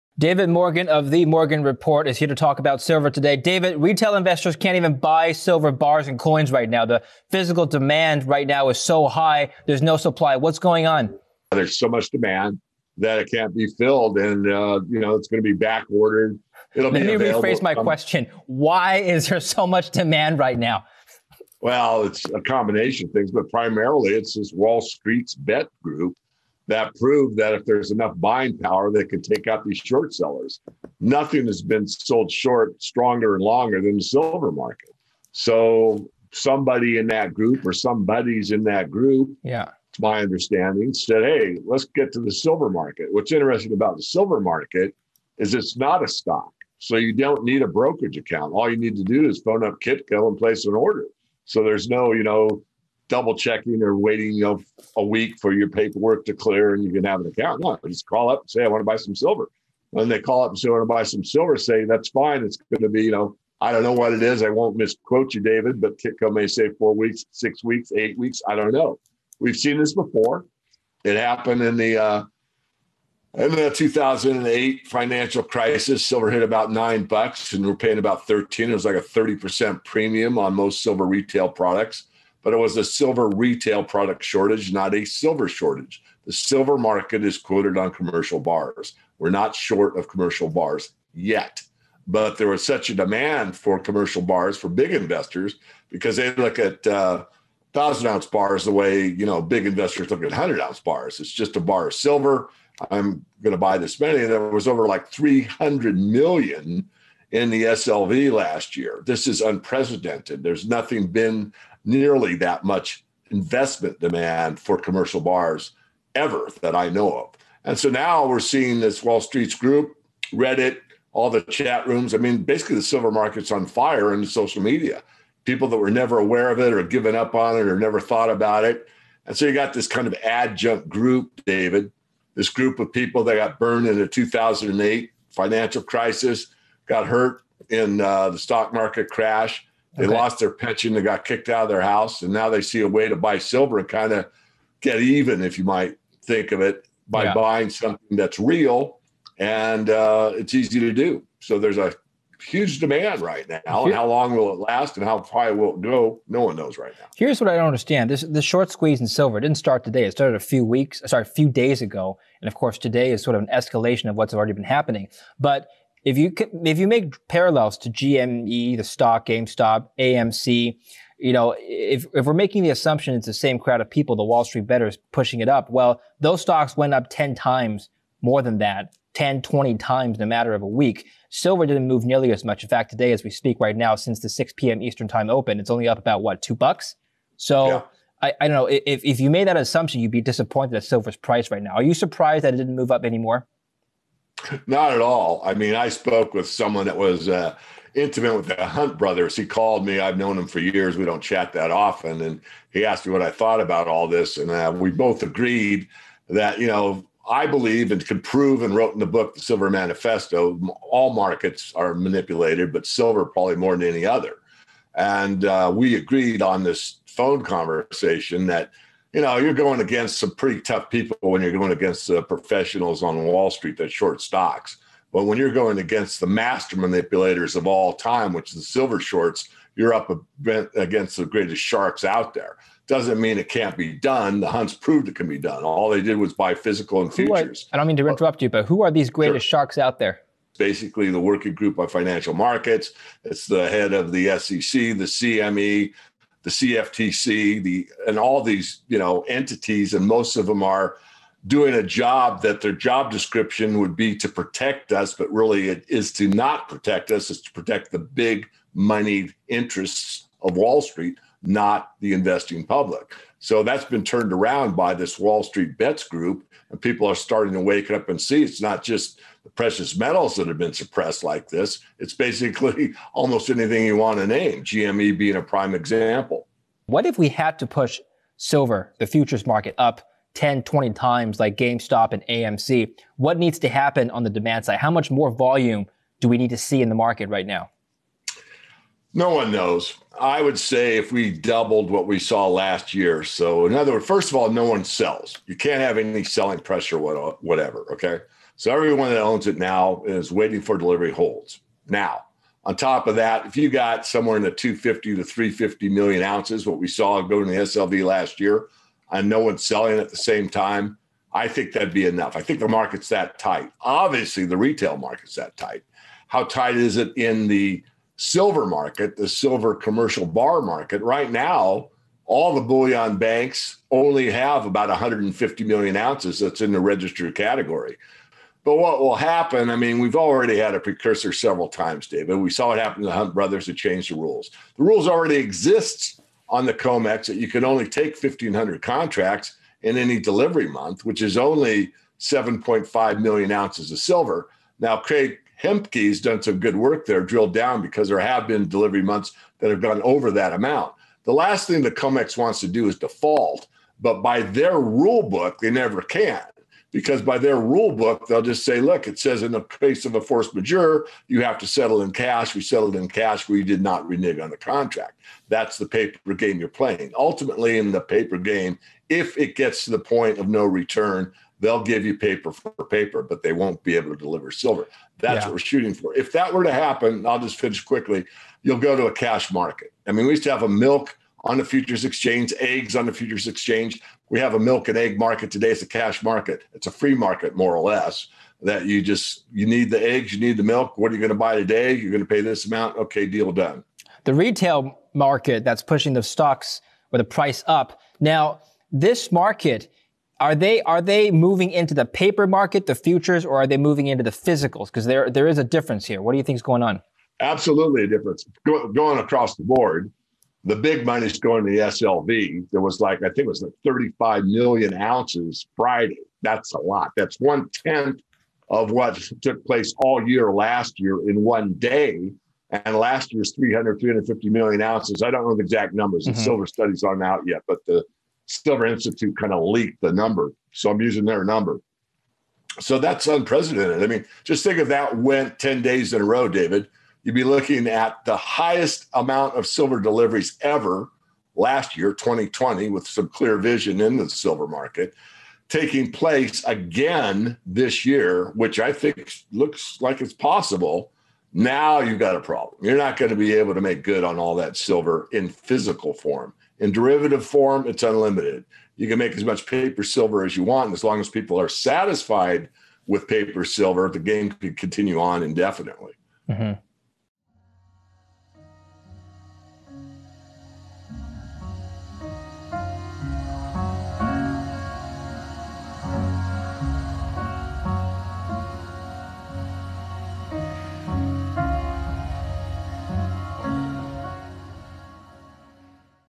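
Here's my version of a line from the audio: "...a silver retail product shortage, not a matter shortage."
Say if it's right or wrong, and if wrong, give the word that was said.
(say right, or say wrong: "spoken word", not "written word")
wrong: "silver", not "matter".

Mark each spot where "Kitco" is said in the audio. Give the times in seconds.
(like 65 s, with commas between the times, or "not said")
49 s, 65 s.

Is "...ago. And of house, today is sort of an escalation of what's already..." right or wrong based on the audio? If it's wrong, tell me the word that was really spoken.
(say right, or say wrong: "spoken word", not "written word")
wrong: "course", not "house".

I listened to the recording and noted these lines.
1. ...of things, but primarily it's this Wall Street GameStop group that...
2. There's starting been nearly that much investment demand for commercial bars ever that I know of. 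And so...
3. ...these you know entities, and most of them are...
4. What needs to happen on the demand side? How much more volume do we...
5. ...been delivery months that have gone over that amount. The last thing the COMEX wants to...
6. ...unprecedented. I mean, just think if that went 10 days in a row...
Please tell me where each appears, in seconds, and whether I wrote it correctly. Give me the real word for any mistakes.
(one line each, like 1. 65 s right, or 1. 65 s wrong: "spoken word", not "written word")
1. 23 s wrong: "Bets", not "GameStop"
2. 110 s wrong: "nothing", not "starting"
3. 248 s right
4. 283 s right
5. 348 s right
6. 433 s right.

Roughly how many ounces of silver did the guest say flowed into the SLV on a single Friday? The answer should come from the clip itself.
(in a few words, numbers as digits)
35 million ounces.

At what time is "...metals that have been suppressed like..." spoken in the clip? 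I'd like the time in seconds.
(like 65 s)
269 s.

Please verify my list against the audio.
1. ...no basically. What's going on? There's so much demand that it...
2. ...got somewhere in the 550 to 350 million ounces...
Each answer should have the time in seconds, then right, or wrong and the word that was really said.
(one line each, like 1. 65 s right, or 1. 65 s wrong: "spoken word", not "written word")
1. 9 s wrong: "supply", not "basically"
2. 303 s wrong: "250", not "550".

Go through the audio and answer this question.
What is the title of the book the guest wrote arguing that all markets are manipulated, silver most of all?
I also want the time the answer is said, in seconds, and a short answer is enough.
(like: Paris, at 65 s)
The Silver Manifesto, at 209 s.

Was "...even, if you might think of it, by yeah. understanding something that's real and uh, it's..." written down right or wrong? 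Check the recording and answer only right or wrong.
wrong.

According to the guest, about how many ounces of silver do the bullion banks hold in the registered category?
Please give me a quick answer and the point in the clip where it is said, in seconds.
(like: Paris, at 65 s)
150 million ounces, at 324 s.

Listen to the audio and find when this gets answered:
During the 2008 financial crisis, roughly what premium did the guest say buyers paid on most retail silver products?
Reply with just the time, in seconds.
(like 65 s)
79 s.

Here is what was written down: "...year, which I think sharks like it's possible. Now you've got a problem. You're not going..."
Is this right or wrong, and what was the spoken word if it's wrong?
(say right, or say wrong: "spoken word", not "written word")
wrong: "looks", not "sharks".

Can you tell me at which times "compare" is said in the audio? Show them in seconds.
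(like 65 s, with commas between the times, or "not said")
not said.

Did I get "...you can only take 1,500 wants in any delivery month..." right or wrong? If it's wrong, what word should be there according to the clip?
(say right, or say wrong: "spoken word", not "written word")
wrong: "contracts", not "wants".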